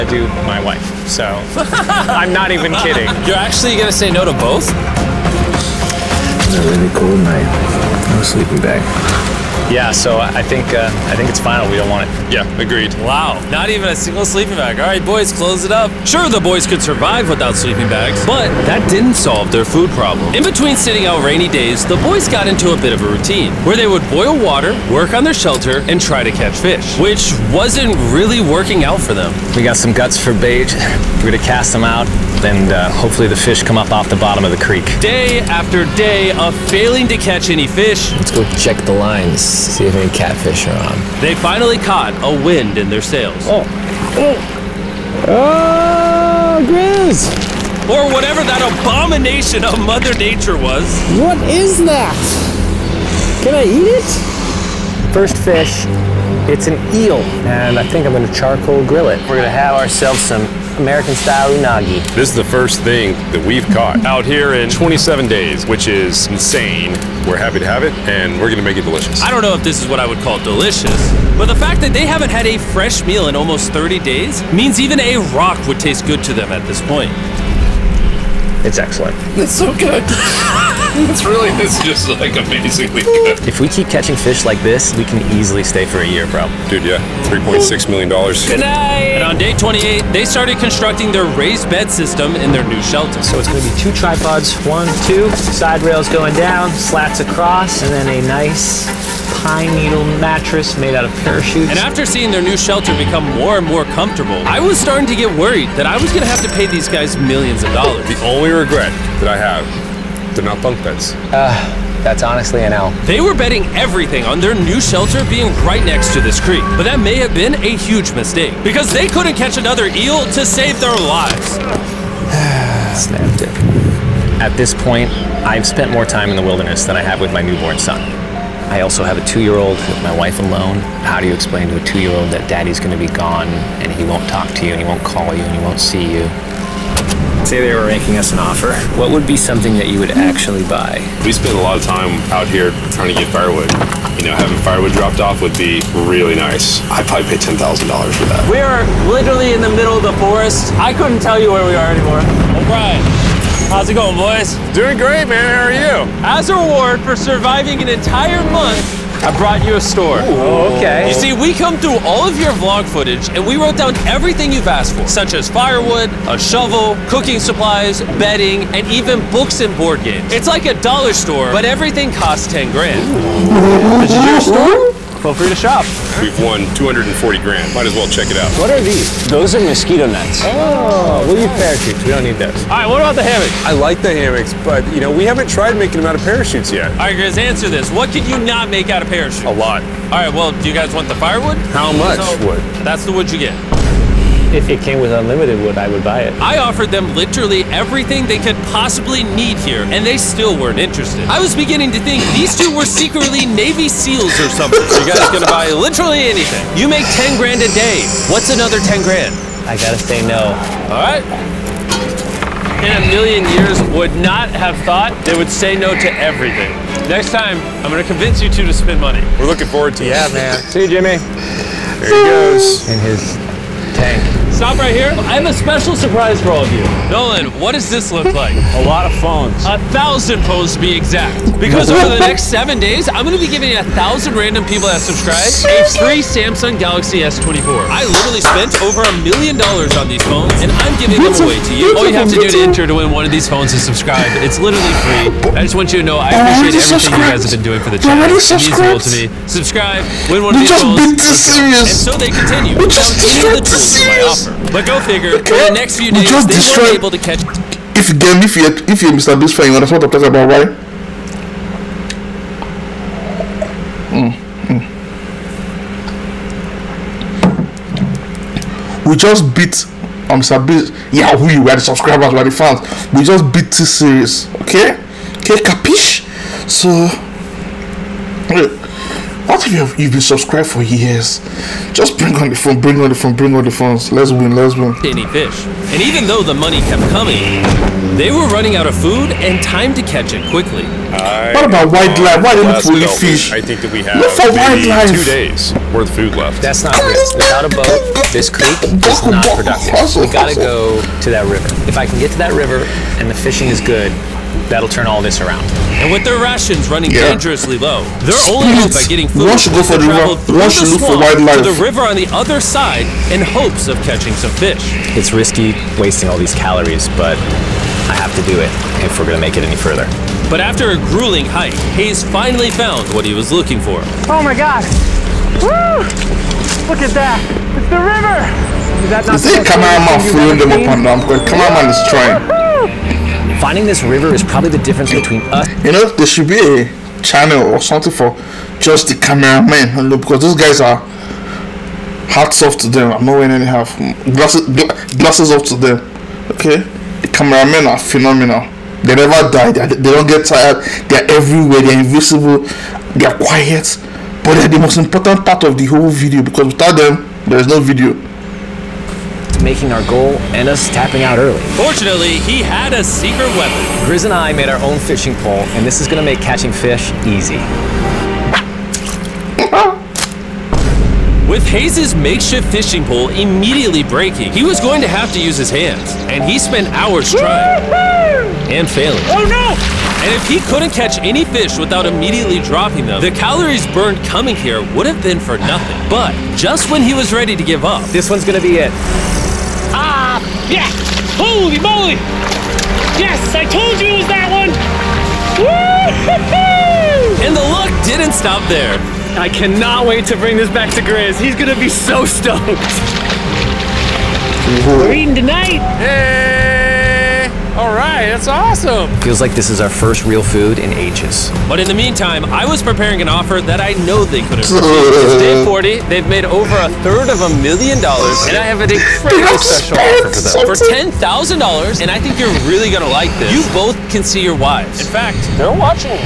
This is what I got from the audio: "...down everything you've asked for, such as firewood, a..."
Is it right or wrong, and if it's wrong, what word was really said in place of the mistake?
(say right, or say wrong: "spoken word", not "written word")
right.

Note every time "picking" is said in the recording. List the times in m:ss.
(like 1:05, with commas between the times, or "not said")
not said.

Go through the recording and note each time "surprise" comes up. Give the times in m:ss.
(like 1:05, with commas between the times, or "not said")
3:45.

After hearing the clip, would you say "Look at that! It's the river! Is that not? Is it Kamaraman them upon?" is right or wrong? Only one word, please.
right.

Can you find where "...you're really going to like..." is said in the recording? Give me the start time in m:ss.
7:02.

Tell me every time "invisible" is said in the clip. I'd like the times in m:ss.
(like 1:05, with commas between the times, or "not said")
5:51.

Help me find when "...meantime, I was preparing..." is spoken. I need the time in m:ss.
6:51.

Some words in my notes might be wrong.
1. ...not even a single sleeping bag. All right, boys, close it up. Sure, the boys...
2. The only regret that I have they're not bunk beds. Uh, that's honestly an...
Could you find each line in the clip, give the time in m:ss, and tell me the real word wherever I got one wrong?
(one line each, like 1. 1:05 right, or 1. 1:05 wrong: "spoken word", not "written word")
1. 0:13 right
2. 1:48 right.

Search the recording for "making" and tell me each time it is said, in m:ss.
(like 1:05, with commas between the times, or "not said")
2:17, 3:05, 5:59.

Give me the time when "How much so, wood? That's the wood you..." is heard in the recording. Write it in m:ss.
3:11.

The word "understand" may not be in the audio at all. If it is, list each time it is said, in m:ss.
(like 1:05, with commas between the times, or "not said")
4:19.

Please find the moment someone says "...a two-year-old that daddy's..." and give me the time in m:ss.
2:11.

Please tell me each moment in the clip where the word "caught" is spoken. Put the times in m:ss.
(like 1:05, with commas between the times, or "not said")
0:41, 1:03.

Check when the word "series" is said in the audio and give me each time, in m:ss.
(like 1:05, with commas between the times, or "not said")
4:33.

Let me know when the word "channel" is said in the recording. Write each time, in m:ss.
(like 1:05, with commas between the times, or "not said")
4:07, 5:37.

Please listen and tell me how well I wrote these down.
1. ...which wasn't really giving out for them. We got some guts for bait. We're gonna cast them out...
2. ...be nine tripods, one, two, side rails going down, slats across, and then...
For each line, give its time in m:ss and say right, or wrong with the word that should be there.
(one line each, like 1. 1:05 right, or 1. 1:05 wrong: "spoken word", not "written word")
1. 0:26 wrong: "working", not "giving"
2. 1:33 wrong: "two", not "nine".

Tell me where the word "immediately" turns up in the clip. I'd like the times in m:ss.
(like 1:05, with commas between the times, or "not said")
6:13, 6:22.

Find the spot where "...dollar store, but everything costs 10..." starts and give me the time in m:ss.
2:50.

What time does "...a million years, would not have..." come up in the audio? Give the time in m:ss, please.
3:32.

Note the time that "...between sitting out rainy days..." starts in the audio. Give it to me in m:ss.
0:20.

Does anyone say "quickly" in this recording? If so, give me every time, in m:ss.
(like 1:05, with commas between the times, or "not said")
4:50.